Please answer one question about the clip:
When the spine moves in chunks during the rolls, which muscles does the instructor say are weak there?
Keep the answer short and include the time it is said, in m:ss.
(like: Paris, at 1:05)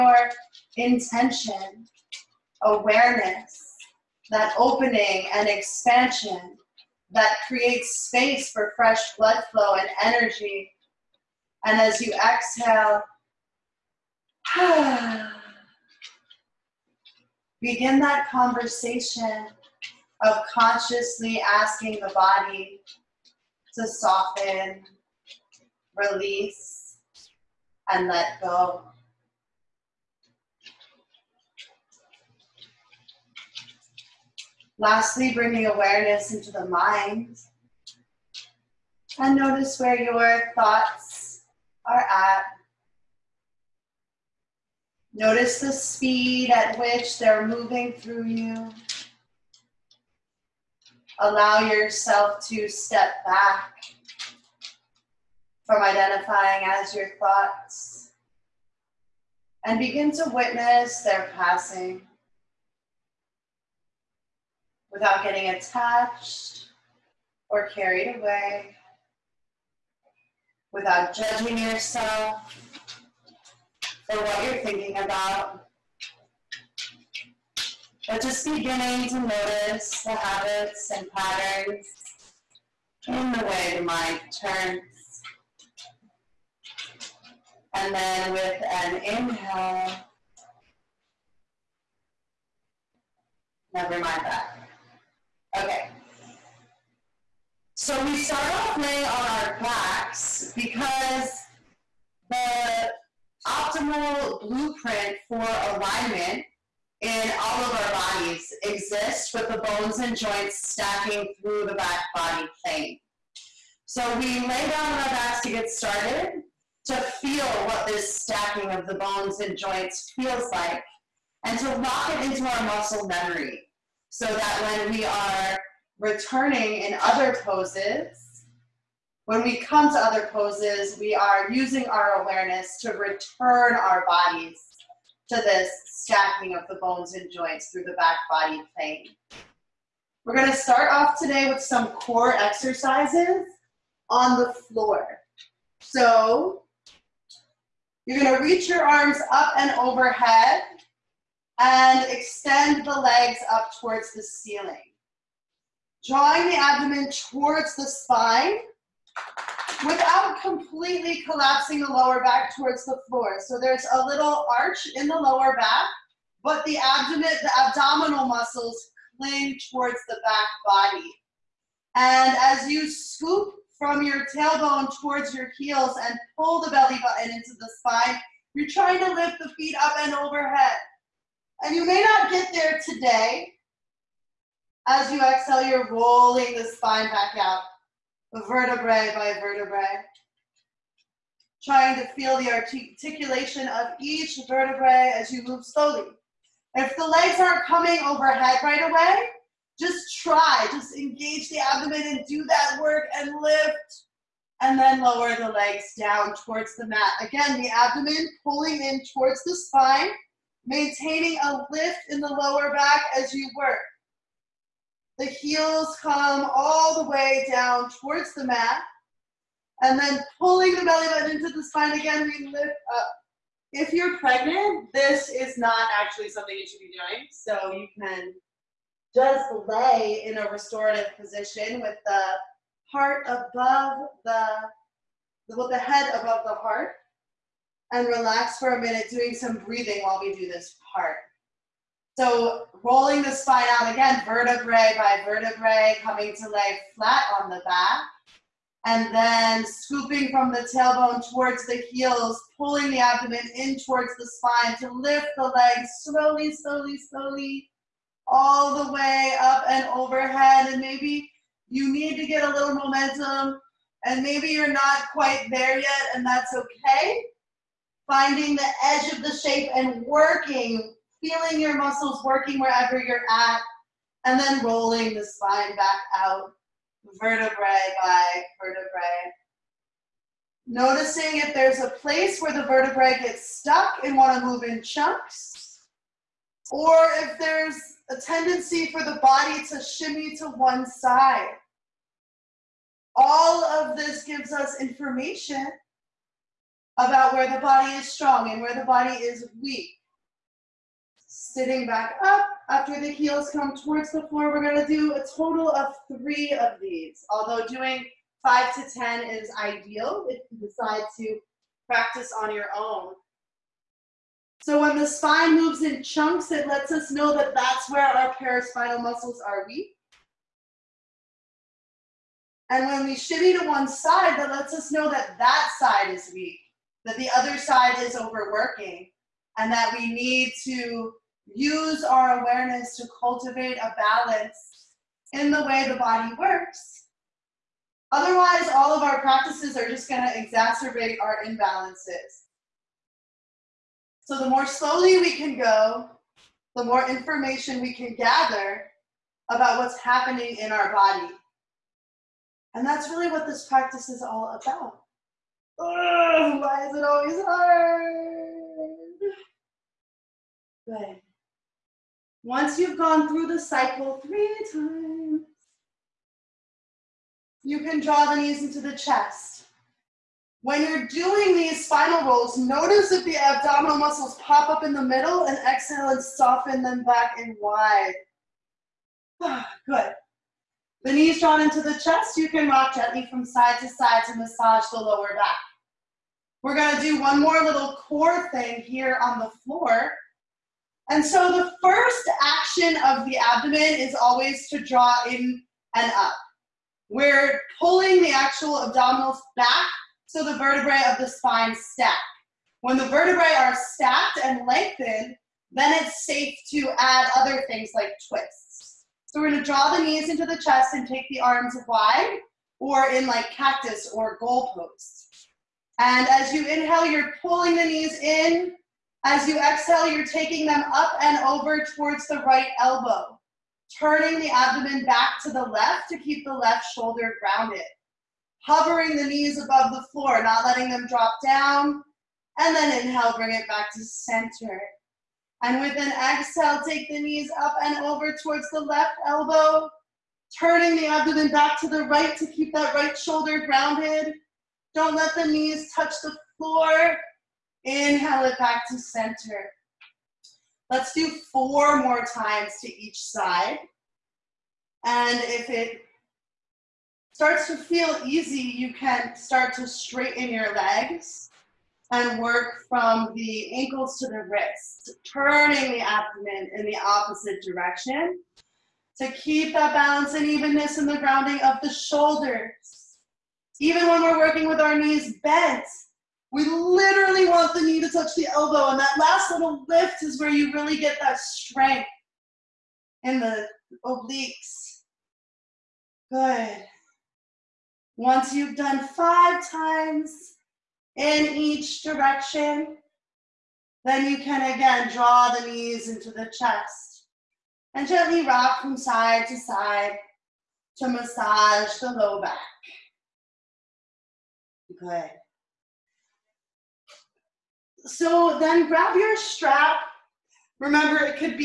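paraspinal muscles, at 5:18.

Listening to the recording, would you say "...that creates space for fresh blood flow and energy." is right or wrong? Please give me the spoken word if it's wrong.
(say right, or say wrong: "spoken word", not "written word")
right.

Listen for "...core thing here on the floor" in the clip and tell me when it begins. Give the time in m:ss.
6:28.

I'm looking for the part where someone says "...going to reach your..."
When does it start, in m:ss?
2:28.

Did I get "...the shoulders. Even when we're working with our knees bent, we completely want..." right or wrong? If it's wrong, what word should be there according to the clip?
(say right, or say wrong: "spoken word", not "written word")
wrong: "literally", not "completely".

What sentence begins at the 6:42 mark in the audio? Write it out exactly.
When the vertebrae are stacked and lengthened, then it's safe to add other things like twists.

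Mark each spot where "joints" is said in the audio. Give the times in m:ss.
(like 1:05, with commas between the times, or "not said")
1:50, 1:59, 2:17.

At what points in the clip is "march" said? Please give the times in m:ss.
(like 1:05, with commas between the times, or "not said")
not said.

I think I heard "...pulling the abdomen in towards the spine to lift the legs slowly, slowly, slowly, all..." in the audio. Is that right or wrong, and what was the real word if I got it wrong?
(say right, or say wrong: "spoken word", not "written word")
right.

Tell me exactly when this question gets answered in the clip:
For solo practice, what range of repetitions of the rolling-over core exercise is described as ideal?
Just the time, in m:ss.
5:08.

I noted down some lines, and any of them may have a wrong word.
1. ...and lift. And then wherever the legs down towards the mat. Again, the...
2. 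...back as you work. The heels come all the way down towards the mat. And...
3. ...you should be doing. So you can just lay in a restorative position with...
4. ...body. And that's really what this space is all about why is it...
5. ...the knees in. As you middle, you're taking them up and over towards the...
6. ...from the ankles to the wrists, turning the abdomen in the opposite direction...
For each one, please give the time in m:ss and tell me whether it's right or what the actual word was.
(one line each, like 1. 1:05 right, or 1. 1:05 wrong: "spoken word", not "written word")
1. 3:23 wrong: "lower", not "wherever"
2. 3:32 right
3. 3:46 right
4. 5:50 wrong: "practice", not "space"
5. 6:57 wrong: "exhale", not "middle"
6. 7:42 right.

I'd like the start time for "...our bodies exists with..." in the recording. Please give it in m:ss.
1:47.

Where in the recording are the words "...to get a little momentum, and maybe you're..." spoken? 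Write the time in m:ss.
4:22.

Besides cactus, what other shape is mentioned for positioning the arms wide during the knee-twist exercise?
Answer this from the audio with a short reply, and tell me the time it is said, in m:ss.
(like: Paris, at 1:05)
goal posts, at 6:54.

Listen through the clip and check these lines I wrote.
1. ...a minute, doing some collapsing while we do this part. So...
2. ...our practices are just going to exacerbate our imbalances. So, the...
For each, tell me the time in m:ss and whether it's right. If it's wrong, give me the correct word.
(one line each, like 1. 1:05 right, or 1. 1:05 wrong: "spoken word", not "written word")
1. 3:58 wrong: "breathing", not "collapsing"
2. 5:39 right.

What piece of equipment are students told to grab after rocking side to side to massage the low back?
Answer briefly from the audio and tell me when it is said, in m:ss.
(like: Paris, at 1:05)
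strap, at 8:29.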